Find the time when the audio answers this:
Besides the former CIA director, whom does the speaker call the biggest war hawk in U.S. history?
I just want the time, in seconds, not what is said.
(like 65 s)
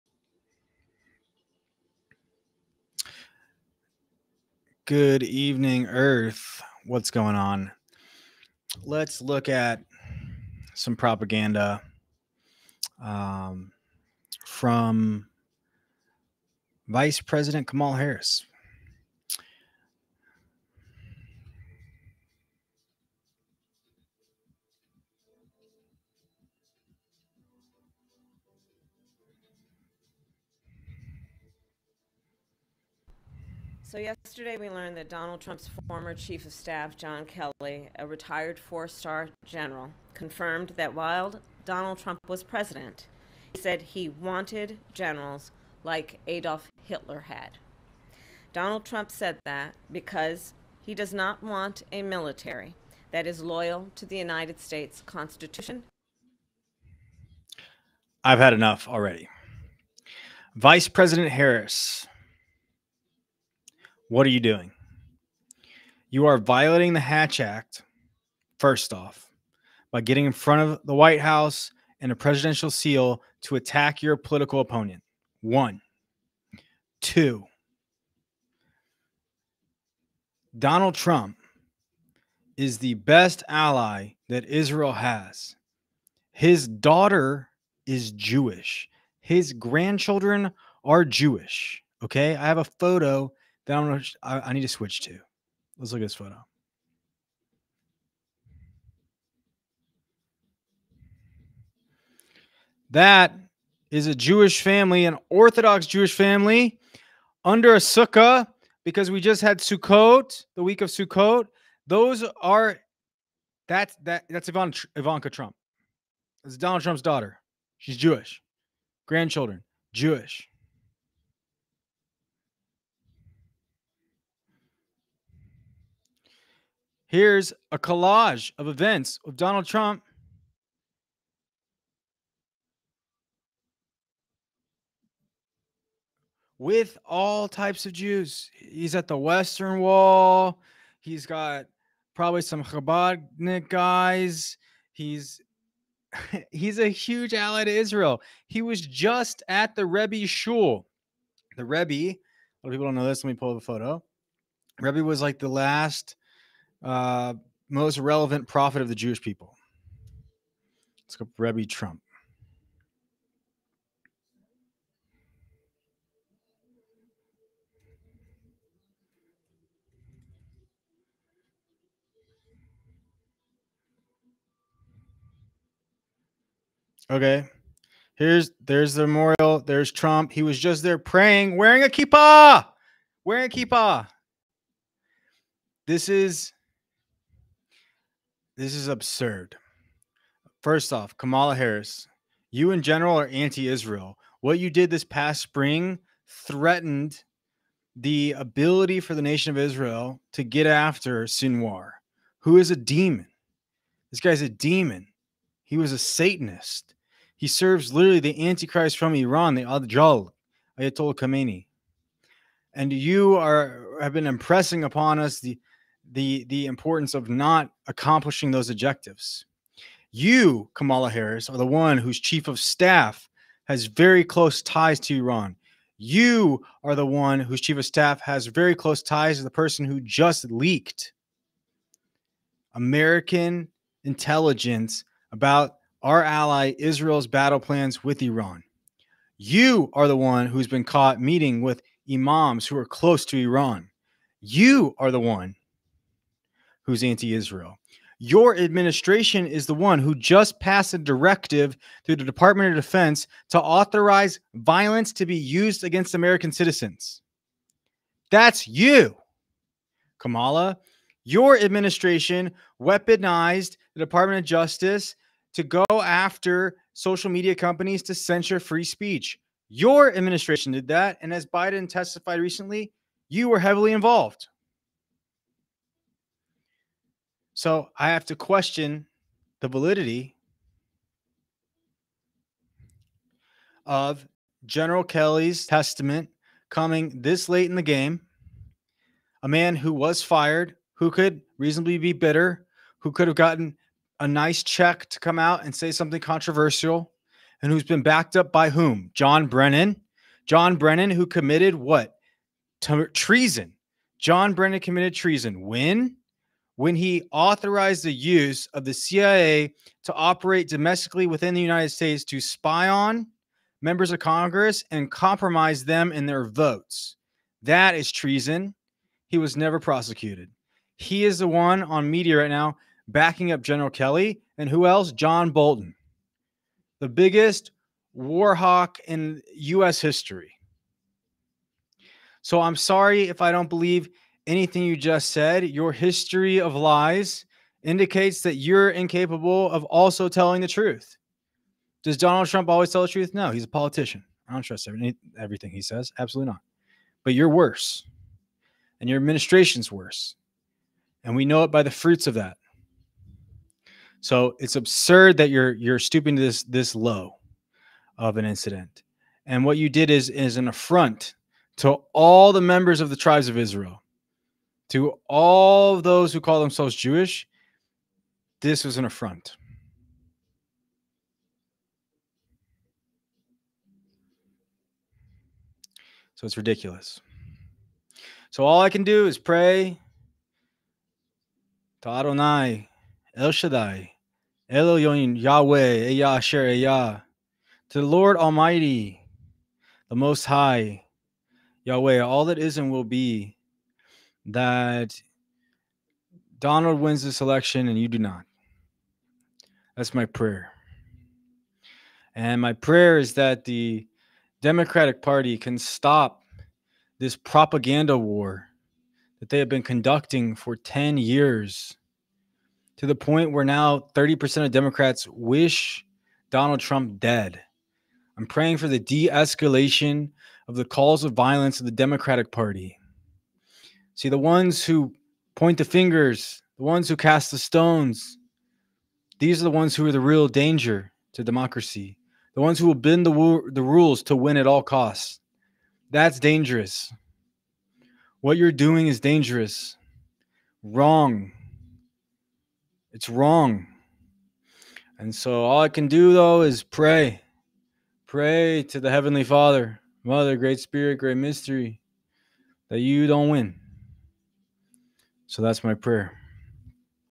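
325 s.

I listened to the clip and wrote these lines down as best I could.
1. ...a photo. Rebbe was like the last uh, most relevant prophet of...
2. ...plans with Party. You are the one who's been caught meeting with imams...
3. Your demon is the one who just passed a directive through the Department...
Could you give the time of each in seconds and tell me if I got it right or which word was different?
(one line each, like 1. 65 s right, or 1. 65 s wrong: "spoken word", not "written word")
1. 153 s right
2. 237 s wrong: "Iran", not "Party"
3. 248 s wrong: "administration", not "demon".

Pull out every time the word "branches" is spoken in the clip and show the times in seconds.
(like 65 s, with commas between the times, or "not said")
not said.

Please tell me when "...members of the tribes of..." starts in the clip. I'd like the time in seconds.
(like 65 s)
362 s.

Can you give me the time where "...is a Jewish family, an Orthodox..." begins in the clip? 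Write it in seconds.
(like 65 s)
103 s.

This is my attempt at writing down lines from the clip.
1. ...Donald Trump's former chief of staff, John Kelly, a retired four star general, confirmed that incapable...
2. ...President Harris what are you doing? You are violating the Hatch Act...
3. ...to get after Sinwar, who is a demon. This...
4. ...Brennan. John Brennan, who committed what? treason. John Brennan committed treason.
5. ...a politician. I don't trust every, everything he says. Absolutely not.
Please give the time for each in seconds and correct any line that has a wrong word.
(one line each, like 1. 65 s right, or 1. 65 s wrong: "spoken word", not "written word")
1. 35 s wrong: "while", not "incapable"
2. 60 s right
3. 200 s right
4. 299 s right
5. 343 s right.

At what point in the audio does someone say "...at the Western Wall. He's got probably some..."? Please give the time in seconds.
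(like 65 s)
138 s.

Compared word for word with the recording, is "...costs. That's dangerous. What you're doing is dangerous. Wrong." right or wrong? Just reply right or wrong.
right.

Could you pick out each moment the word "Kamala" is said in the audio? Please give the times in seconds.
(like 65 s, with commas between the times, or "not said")
17 s, 191 s, 220 s, 260 s.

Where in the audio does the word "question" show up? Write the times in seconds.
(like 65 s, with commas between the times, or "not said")
278 s.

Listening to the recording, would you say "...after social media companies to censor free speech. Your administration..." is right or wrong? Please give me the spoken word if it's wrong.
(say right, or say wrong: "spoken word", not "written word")
right.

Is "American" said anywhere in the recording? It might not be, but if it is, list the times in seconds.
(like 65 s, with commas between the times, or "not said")
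232 s, 256 s.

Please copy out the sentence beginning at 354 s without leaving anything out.
So it's absurd that you're you're stooping to this this low of an incident.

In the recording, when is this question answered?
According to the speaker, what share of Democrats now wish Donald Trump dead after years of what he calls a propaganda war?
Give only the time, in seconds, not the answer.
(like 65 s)
414 s.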